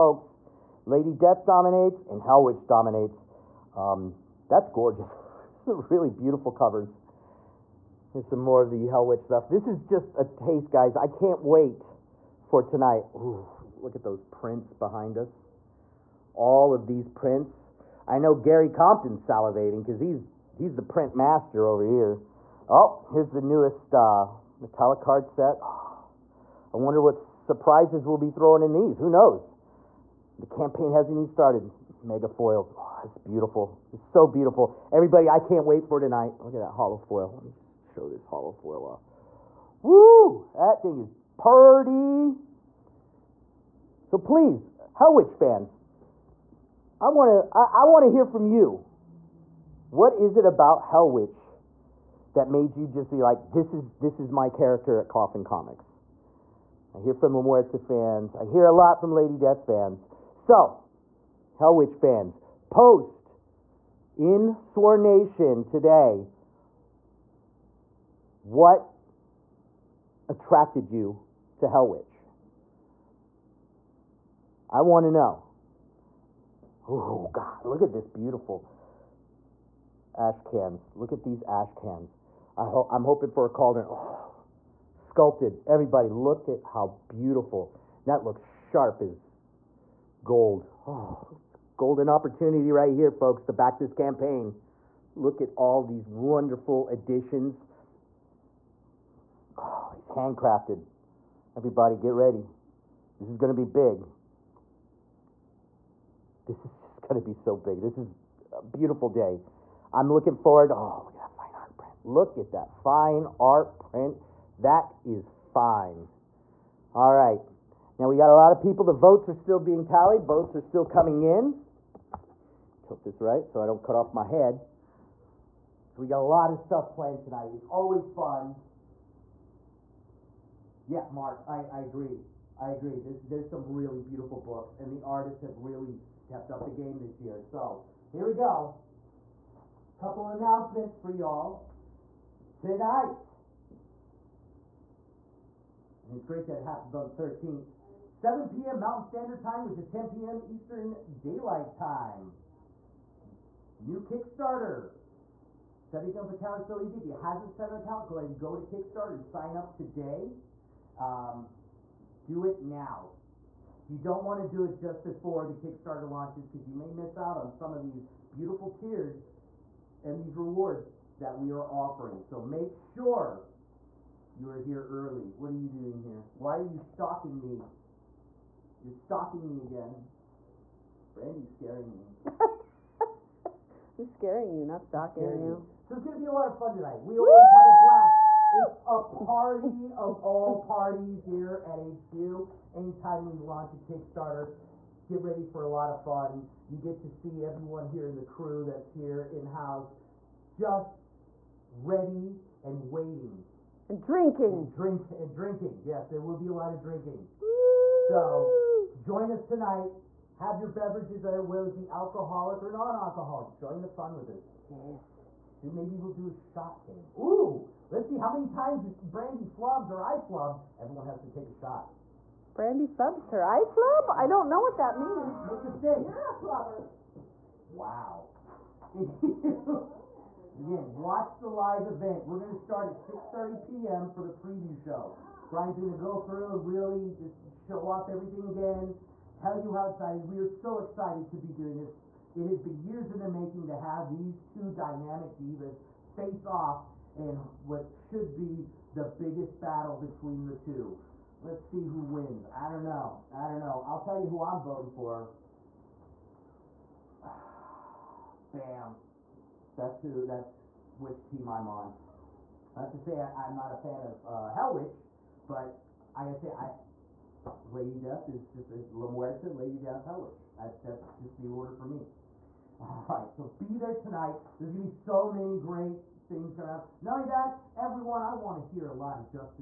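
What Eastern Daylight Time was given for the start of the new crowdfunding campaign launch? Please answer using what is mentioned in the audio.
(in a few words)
10 p.m.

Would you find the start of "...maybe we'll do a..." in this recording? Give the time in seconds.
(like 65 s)
215 s.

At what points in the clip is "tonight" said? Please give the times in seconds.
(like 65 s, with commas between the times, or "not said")
12 s, 35 s, 127 s, 142 s, 186 s, 209 s, 273 s.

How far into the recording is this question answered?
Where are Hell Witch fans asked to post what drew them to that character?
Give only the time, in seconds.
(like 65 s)
64 s.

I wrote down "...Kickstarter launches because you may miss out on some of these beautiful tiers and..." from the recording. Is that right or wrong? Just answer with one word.
right.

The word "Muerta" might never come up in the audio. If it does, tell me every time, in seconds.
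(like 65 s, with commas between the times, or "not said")
57 s, 269 s.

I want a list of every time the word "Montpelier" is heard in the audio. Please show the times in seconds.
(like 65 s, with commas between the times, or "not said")
not said.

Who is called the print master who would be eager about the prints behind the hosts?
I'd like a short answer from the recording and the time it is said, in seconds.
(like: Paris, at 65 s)
Gary Compton, at 18 s.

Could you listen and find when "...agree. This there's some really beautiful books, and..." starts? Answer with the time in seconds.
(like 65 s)
132 s.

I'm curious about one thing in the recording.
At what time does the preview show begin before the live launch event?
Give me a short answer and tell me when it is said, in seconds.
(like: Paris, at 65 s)
6:30 p.m., at 232 s.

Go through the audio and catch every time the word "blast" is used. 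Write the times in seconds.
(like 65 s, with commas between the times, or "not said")
187 s.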